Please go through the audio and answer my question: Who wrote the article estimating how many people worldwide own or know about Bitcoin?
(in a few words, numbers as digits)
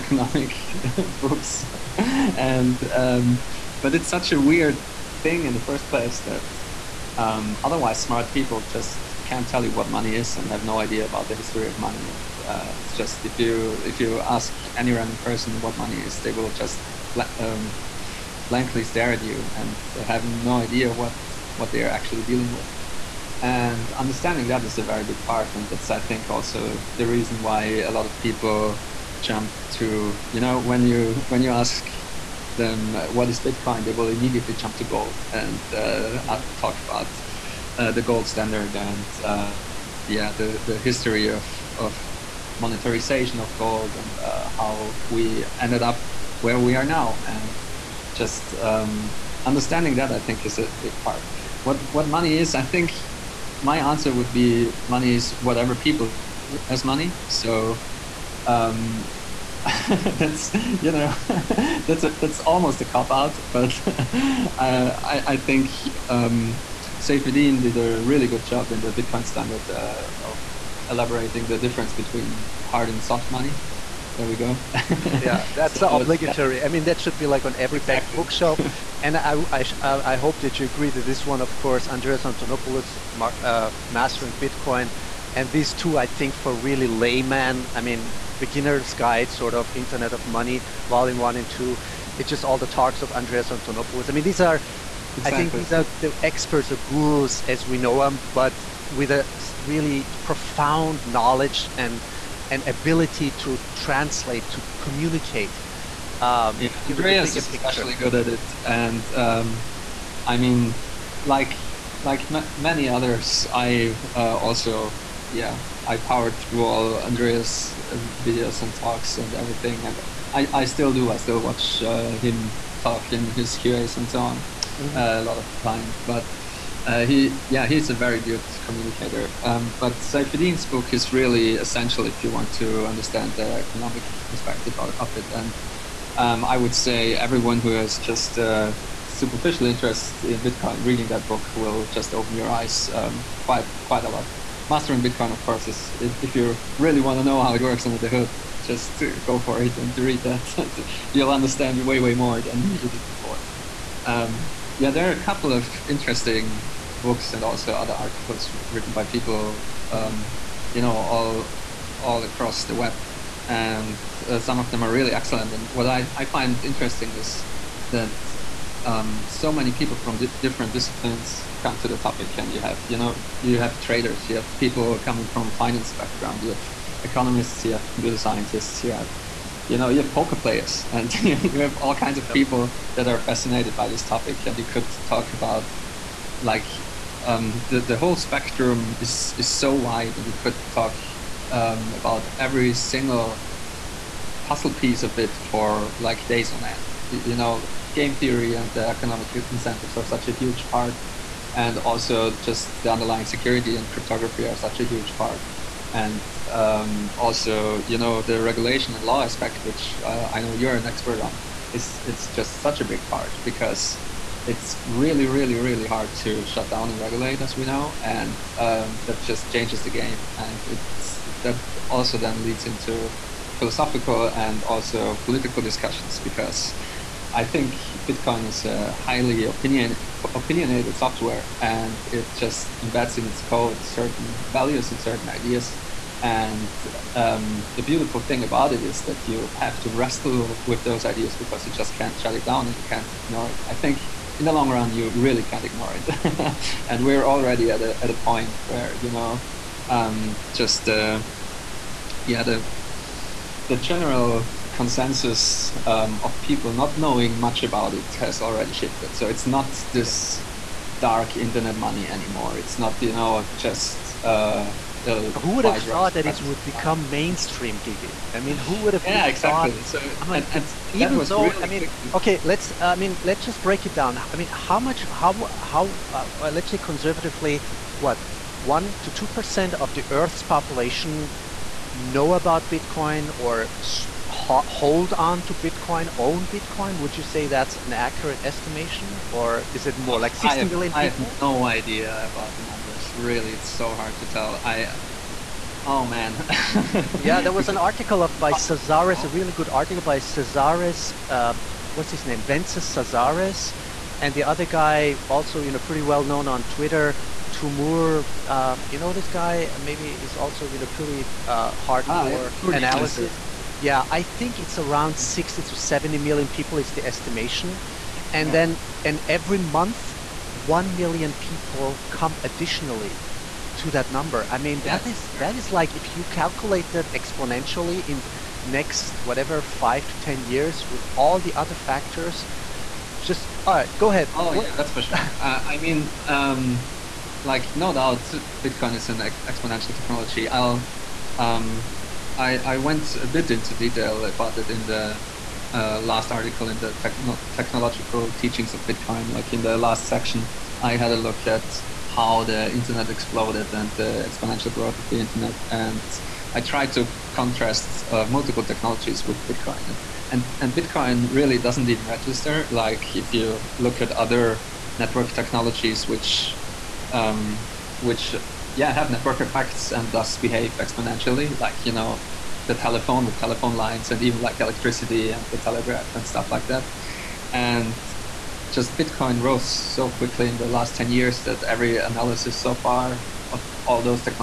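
Wences Casares.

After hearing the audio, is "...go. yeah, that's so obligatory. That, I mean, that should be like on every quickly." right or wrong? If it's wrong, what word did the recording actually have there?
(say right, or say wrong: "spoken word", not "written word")
wrong: "exactly", not "quickly".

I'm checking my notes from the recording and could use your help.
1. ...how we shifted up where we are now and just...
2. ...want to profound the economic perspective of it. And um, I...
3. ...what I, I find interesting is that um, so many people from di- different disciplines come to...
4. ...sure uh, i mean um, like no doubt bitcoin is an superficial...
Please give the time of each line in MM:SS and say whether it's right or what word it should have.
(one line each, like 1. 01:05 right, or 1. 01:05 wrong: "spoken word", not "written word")
1. 00:44 wrong: "ended", not "shifted"
2. 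02:12 wrong: "understand", not "profound"
3. 02:45 right
4. 05:35 wrong: "exponential", not "superficial".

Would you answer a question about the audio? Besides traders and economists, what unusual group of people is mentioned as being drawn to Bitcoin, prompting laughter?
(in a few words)
Poker players.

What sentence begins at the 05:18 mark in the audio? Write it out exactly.
then and every month one million people come additionally to that number i mean yeah.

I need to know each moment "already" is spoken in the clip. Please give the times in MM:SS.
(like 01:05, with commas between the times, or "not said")
04:07, 04:18.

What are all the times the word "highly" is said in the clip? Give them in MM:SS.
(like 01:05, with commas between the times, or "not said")
03:49.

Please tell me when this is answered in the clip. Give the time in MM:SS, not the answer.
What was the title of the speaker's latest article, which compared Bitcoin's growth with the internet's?
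05:47.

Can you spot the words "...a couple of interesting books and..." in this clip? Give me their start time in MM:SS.
02:35.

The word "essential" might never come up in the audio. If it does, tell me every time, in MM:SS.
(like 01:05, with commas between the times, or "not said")
02:11.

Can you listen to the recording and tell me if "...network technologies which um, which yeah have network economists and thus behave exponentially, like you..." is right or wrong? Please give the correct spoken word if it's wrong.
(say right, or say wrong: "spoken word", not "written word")
wrong: "effects", not "economists".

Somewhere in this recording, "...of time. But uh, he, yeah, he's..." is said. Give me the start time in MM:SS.
02:05.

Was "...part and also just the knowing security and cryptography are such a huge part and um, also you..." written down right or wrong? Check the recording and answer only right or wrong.
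wrong.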